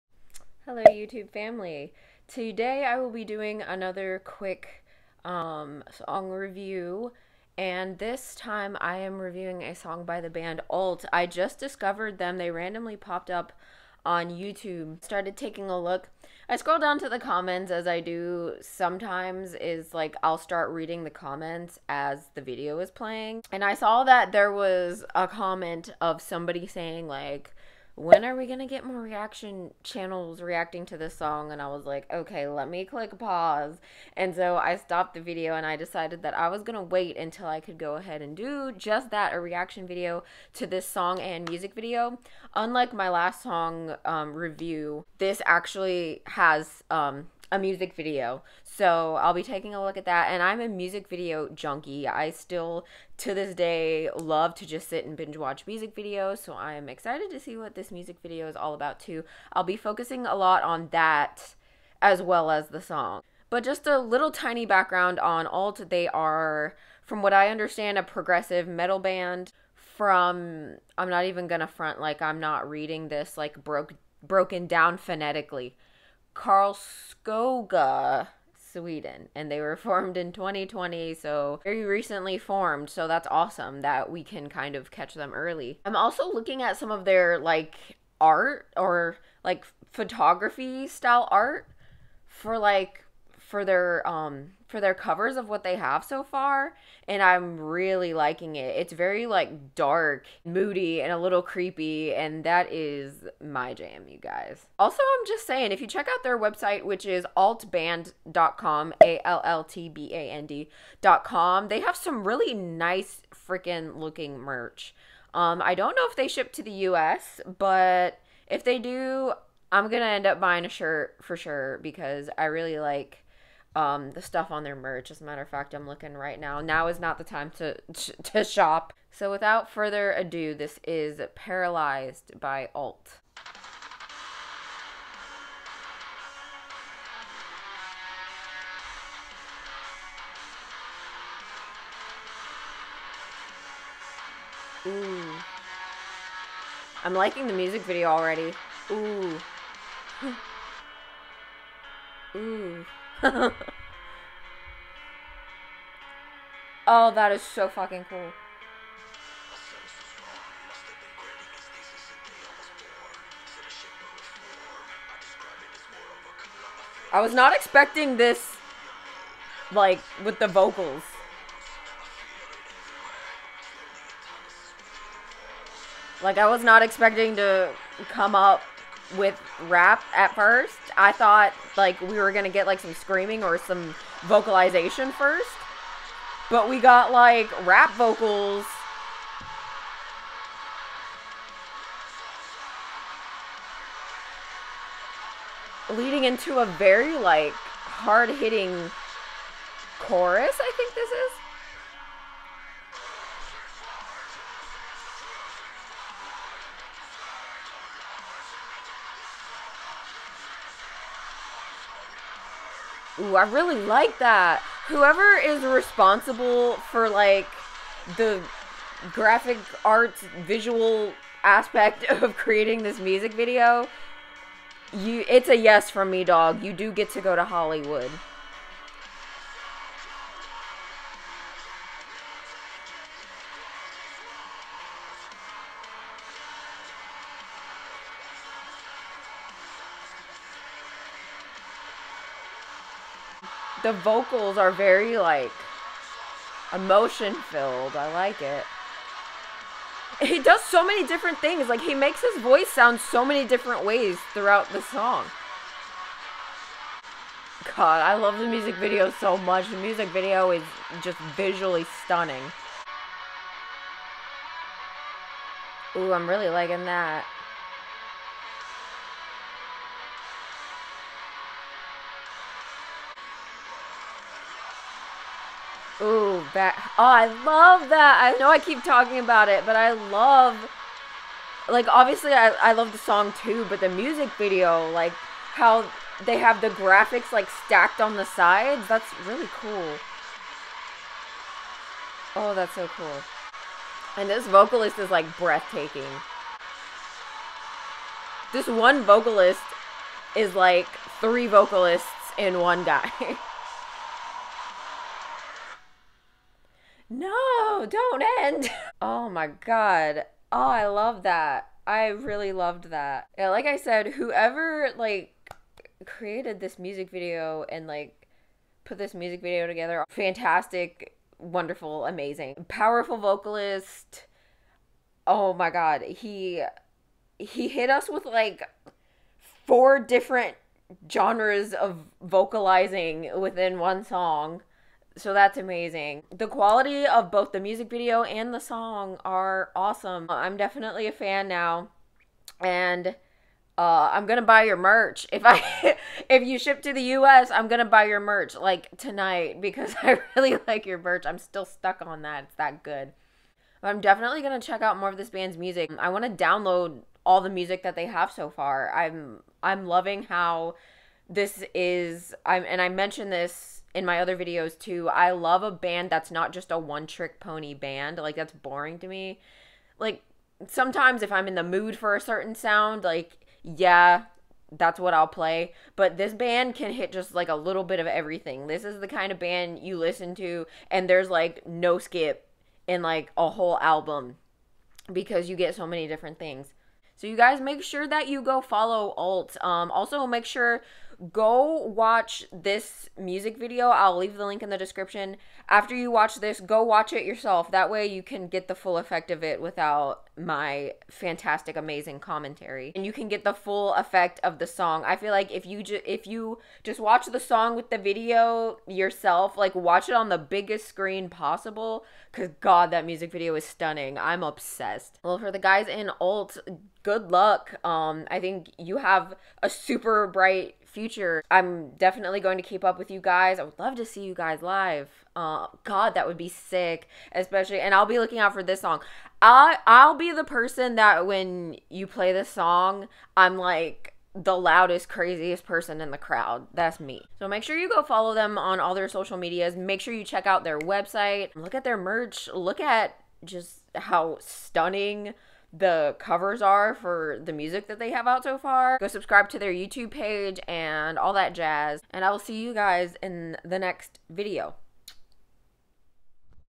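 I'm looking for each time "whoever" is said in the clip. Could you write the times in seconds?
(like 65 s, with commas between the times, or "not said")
214 s, 314 s.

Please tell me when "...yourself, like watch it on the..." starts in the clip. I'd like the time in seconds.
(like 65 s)
408 s.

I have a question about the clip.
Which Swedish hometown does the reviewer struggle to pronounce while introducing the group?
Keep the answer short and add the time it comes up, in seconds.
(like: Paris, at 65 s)
Karlskoga, at 76 s.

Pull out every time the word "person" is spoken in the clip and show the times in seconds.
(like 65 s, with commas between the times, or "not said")
430 s, 435 s.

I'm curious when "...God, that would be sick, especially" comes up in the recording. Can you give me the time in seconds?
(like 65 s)
425 s.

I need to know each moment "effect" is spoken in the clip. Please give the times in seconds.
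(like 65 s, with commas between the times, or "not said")
398 s, 403 s.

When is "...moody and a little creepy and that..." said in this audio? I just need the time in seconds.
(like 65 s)
100 s.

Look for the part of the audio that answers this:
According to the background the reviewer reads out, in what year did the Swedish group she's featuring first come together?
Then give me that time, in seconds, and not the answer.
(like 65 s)
80 s.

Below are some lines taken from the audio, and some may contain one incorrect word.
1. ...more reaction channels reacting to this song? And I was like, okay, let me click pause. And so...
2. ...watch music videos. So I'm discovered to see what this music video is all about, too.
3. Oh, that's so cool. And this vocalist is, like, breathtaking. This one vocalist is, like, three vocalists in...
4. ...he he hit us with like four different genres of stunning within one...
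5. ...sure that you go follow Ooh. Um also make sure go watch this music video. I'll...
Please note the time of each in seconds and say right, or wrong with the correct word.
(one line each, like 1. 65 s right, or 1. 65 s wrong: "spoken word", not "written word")
1. 28 s right
2. 55 s wrong: "excited", not "discovered"
3. 292 s right
4. 326 s wrong: "vocalizing", not "stunning"
5. 387 s wrong: "Allt", not "Ooh".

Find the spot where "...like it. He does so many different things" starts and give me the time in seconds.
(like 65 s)
248 s.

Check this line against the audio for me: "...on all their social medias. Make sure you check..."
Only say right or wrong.
right.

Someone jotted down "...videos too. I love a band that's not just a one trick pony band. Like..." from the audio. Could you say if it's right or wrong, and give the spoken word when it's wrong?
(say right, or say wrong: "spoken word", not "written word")
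right.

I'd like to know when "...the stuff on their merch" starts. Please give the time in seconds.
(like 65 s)
124 s.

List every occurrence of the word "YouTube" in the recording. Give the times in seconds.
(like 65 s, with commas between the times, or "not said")
0 s, 14 s, 449 s.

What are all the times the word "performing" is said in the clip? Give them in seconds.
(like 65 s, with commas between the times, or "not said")
not said.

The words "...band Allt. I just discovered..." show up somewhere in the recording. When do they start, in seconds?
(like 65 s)
10 s.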